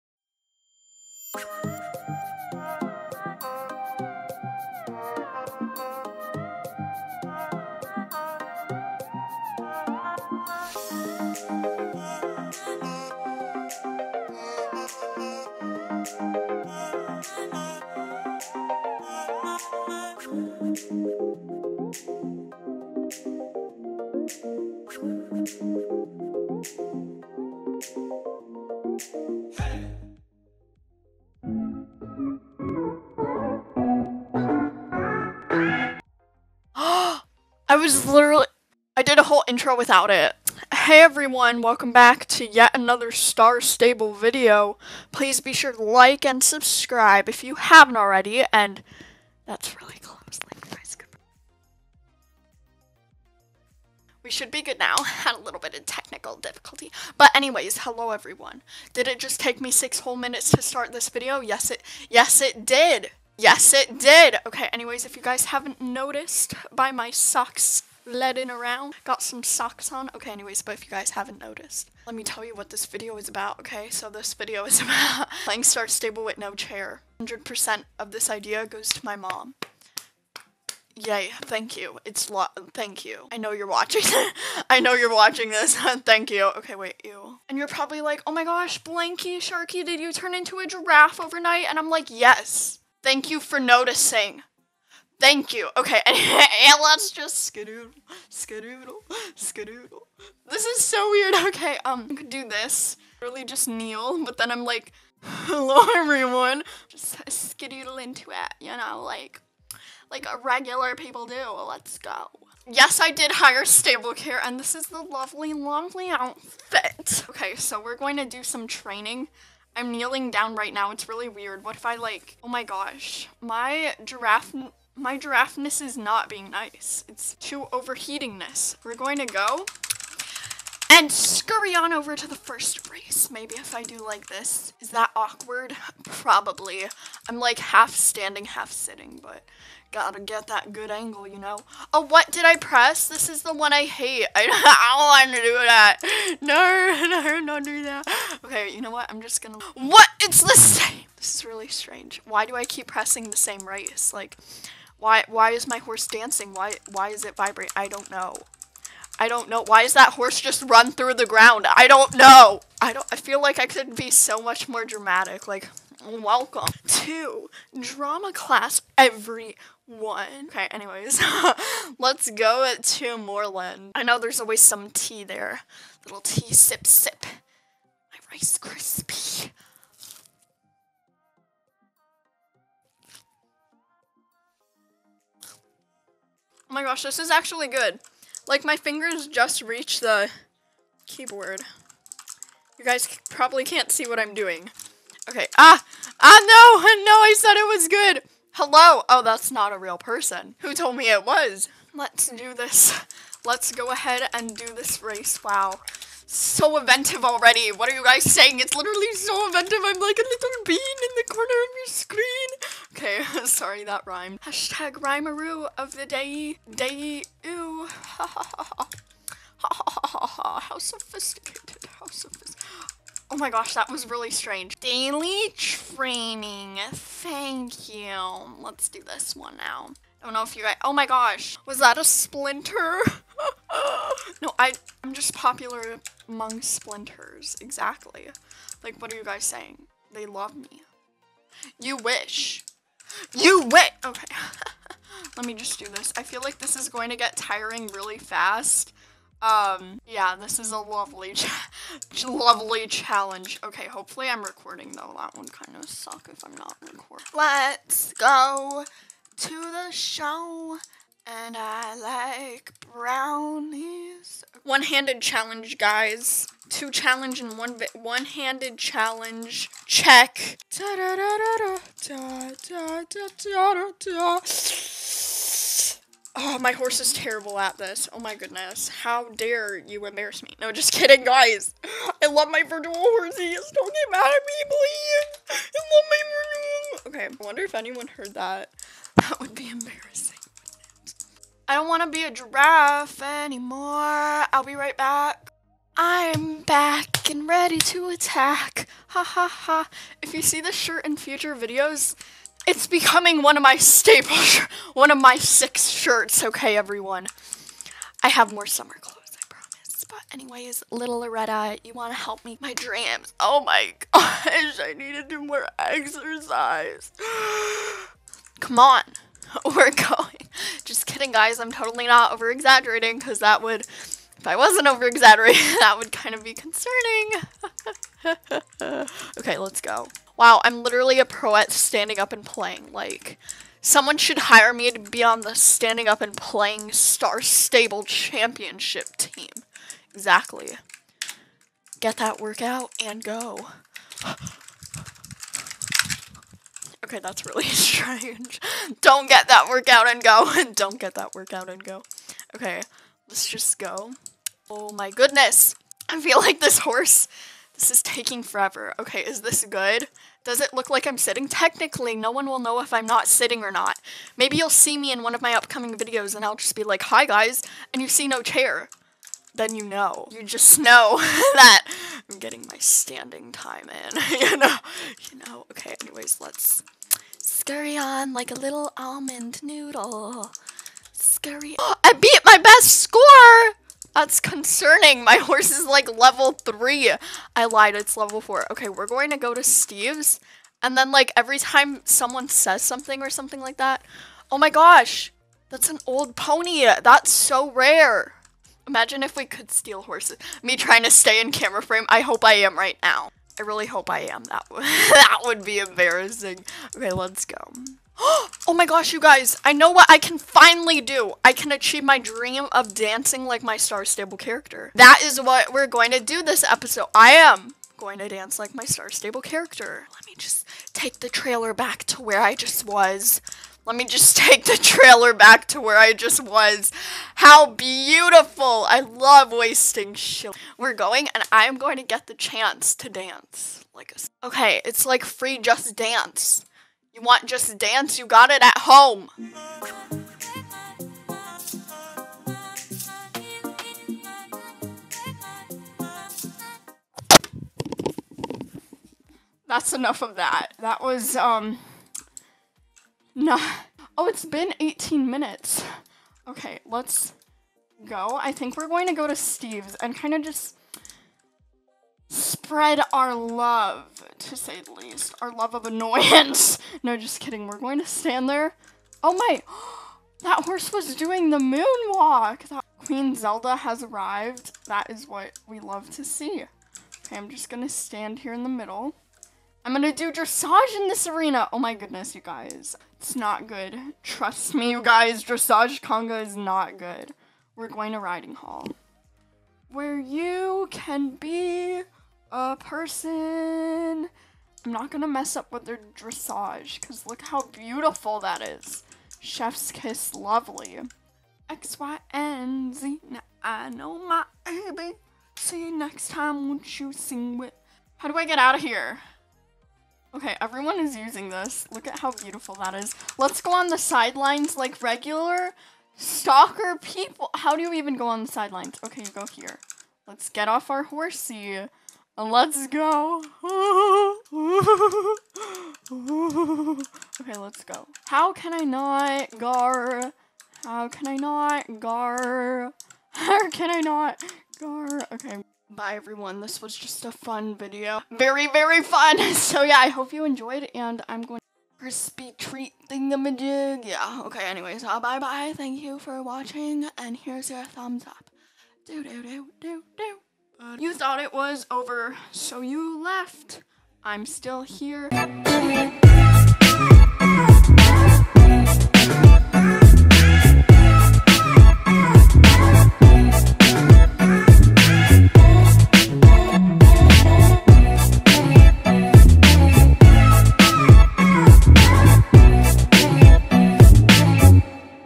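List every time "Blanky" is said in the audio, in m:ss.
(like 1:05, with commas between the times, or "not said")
1:28.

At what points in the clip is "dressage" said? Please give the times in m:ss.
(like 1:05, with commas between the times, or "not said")
8:00, 8:05, 8:16.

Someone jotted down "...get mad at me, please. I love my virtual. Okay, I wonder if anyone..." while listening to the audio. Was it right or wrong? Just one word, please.
right.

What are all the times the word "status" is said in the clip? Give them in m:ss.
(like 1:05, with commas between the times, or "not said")
not said.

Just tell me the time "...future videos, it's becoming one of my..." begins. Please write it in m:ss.
5:01.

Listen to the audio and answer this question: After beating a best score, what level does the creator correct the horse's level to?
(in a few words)
4.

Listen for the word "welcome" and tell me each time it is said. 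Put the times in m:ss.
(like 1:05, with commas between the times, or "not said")
0:41, 2:46.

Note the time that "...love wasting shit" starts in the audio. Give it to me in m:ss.
7:08.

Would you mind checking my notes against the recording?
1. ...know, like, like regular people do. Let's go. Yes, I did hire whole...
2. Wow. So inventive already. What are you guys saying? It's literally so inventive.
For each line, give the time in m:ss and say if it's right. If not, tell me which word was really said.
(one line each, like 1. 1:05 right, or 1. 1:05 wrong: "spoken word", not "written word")
1. 1:48 wrong: "stable", not "whole"
2. 3:25 right.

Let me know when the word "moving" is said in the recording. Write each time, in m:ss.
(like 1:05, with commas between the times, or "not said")
not said.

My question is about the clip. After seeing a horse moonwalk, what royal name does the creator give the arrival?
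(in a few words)
Queen Zelda.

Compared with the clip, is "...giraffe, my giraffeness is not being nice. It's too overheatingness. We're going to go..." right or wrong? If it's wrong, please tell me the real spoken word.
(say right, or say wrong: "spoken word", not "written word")
right.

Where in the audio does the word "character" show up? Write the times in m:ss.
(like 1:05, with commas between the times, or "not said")
6:54, 6:59.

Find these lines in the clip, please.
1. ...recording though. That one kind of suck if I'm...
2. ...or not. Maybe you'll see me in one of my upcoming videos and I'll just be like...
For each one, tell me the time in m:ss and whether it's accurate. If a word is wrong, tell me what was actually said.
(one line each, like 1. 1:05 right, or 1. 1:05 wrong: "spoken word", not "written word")
1. 4:14 right
2. 6:03 right.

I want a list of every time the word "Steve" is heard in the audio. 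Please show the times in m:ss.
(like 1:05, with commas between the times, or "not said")
6:29, 7:39.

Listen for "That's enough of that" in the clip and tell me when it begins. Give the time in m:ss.
7:29.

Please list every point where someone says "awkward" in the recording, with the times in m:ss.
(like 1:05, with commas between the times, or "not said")
2:15.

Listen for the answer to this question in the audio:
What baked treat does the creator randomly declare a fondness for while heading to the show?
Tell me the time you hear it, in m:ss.
4:22.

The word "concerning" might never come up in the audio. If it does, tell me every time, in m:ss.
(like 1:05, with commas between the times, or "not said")
5:26, 6:24.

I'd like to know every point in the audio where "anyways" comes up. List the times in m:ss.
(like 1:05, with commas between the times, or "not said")
0:57, 1:04, 1:10, 2:50, 5:10, 6:16, 9:04.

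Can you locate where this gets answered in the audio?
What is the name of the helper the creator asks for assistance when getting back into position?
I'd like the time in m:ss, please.
5:11.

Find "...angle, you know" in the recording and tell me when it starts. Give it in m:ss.
2:20.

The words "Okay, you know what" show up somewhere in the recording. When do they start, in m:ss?
2:28.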